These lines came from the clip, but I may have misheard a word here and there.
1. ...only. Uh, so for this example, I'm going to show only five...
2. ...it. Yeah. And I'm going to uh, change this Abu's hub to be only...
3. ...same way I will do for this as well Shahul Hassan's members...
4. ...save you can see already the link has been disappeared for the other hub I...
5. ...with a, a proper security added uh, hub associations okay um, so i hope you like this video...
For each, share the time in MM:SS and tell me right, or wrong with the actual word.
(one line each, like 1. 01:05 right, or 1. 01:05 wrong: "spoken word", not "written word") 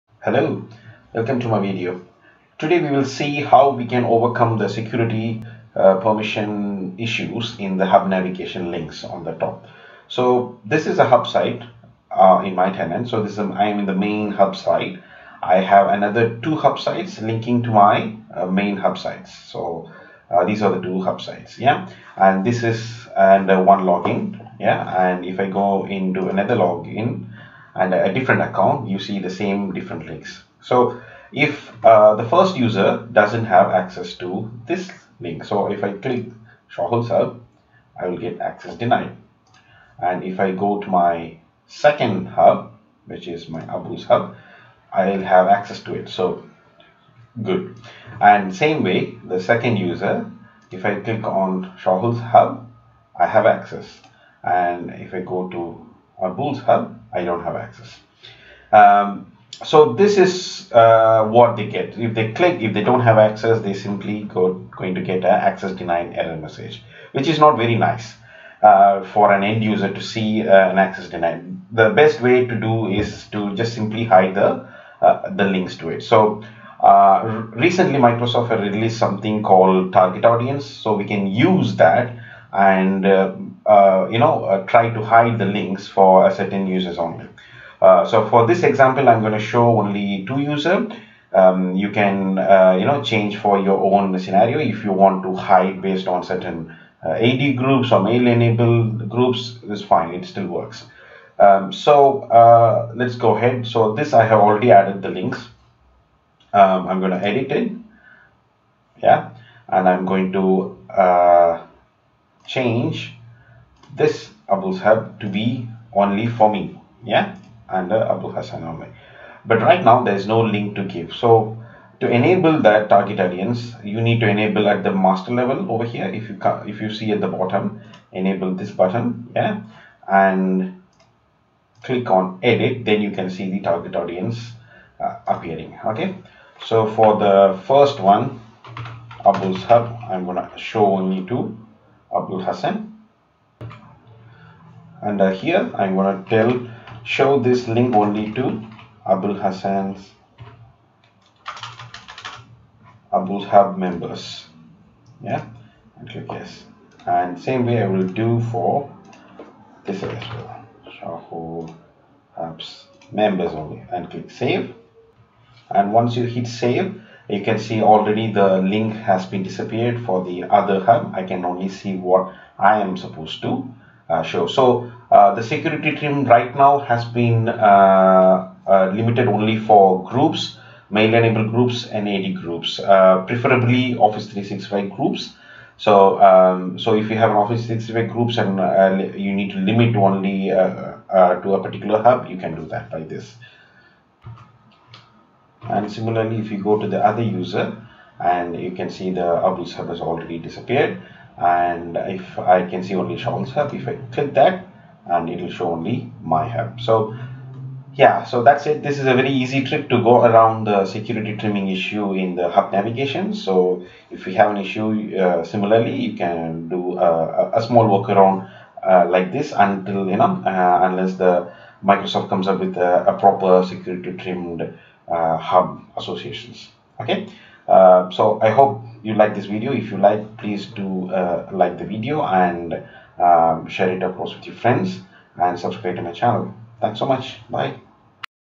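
1. 01:26 wrong: "two", not "five"
2. 01:47 right
3. 02:37 wrong: "Hub", not "Hassan"
4. 02:46 right
5. 03:42 wrong: "trimmed", not "added".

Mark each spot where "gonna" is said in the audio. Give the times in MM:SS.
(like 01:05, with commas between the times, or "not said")
02:20, 02:25.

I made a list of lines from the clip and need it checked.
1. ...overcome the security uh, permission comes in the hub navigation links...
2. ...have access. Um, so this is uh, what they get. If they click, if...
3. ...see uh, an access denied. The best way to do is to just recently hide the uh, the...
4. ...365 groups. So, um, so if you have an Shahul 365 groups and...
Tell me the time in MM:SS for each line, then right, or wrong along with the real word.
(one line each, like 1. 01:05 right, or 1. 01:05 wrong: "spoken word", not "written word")
1. 00:04 wrong: "issues", not "comes"
2. 00:57 right
3. 01:10 wrong: "simply", not "recently"
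4. 03:04 wrong: "Office", not "Shahul".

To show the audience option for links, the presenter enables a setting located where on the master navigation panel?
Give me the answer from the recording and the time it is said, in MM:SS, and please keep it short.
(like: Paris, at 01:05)
At the bottom, at 02:07.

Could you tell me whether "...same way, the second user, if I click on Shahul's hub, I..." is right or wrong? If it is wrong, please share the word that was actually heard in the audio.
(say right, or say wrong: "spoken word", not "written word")
right.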